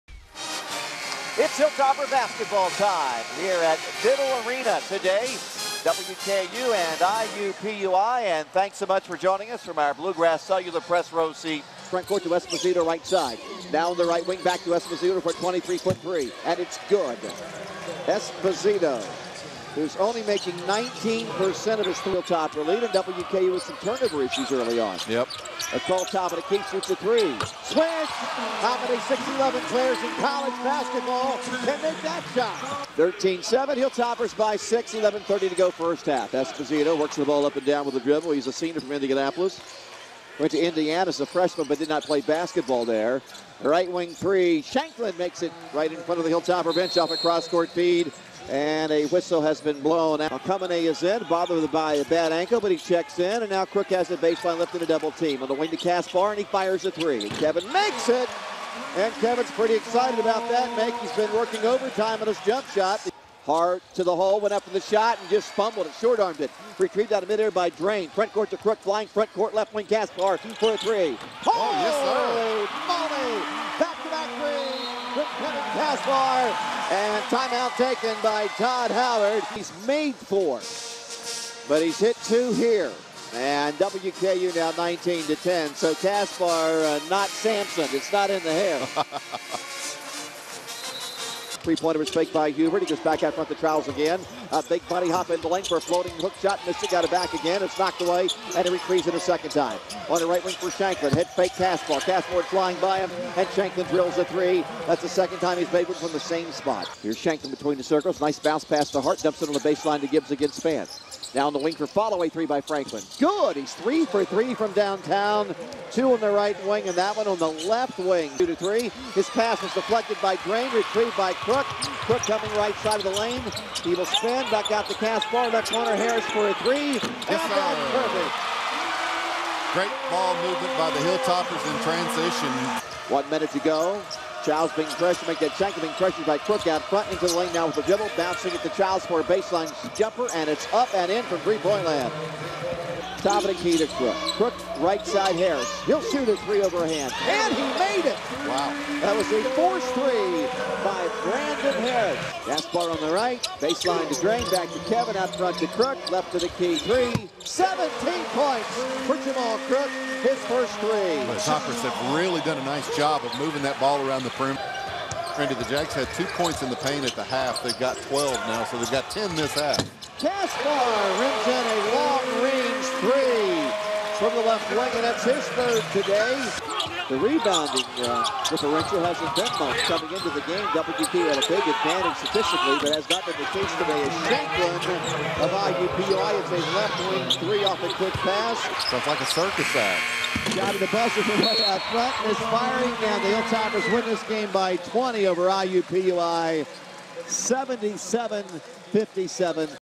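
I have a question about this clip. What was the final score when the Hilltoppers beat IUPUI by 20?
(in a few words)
77-57.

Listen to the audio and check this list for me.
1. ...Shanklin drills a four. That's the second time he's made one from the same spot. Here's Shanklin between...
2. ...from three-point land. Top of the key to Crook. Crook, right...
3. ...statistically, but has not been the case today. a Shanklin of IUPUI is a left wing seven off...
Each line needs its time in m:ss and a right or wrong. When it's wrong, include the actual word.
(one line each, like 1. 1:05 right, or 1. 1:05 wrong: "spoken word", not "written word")
1. 1:43 wrong: "three", not "four"
2. 2:21 right
3. 3:02 wrong: "three", not "seven".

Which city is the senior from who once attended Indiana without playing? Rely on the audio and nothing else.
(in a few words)
Indianapolis.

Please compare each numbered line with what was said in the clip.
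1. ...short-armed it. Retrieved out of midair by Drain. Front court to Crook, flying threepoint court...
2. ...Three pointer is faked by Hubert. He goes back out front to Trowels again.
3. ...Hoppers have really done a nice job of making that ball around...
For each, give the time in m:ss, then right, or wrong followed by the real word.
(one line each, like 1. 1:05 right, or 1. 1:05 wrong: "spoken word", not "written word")
1. 1:05 wrong: "front", not "threepoint"
2. 1:31 right
3. 2:41 wrong: "moving", not "making".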